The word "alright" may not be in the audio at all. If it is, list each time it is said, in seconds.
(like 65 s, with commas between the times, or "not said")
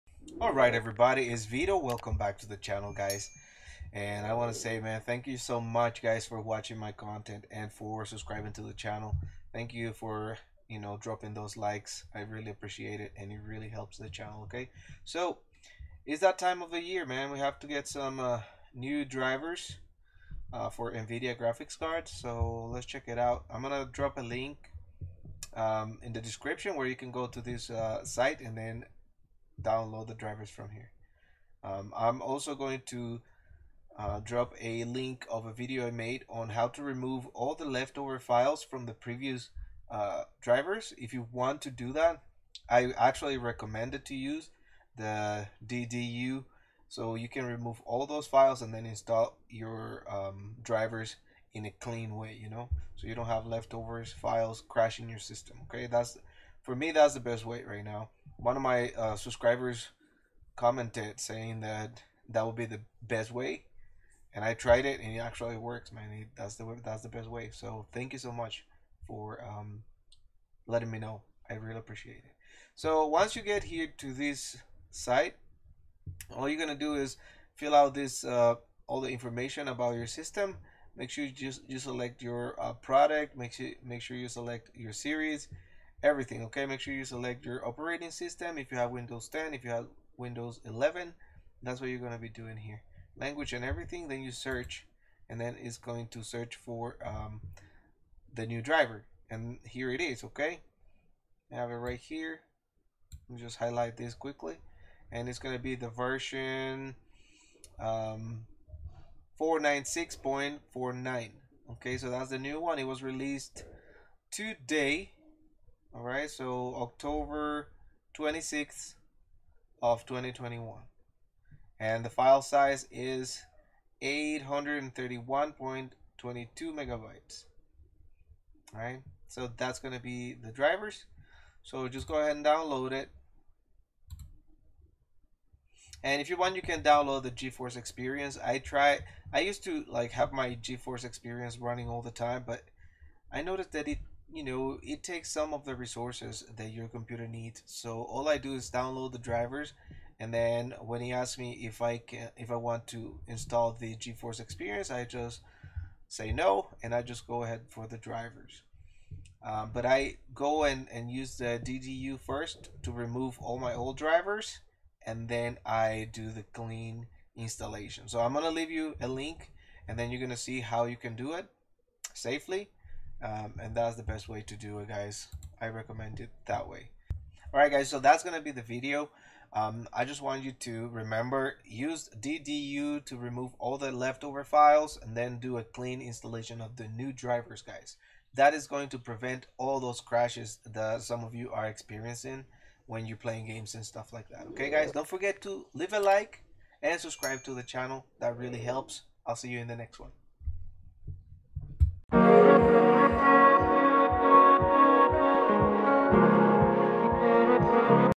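0 s, 177 s.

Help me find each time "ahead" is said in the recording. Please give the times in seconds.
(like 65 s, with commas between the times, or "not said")
132 s, 157 s.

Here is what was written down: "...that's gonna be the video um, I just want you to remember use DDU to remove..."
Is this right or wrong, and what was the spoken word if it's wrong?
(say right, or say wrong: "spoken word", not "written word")
right.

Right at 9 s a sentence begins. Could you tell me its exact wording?
Thank you for, you know, dropping those likes.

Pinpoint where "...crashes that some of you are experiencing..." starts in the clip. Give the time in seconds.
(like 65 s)
189 s.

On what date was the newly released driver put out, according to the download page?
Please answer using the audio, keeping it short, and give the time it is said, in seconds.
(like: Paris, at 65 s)
October 26th 2021, at 116 s.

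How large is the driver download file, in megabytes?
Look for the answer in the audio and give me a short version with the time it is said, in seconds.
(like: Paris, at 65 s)
831.22 megabytes, at 124 s.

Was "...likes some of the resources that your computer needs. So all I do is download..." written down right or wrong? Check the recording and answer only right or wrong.
wrong.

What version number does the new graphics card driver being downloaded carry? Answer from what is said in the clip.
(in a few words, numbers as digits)
496.49.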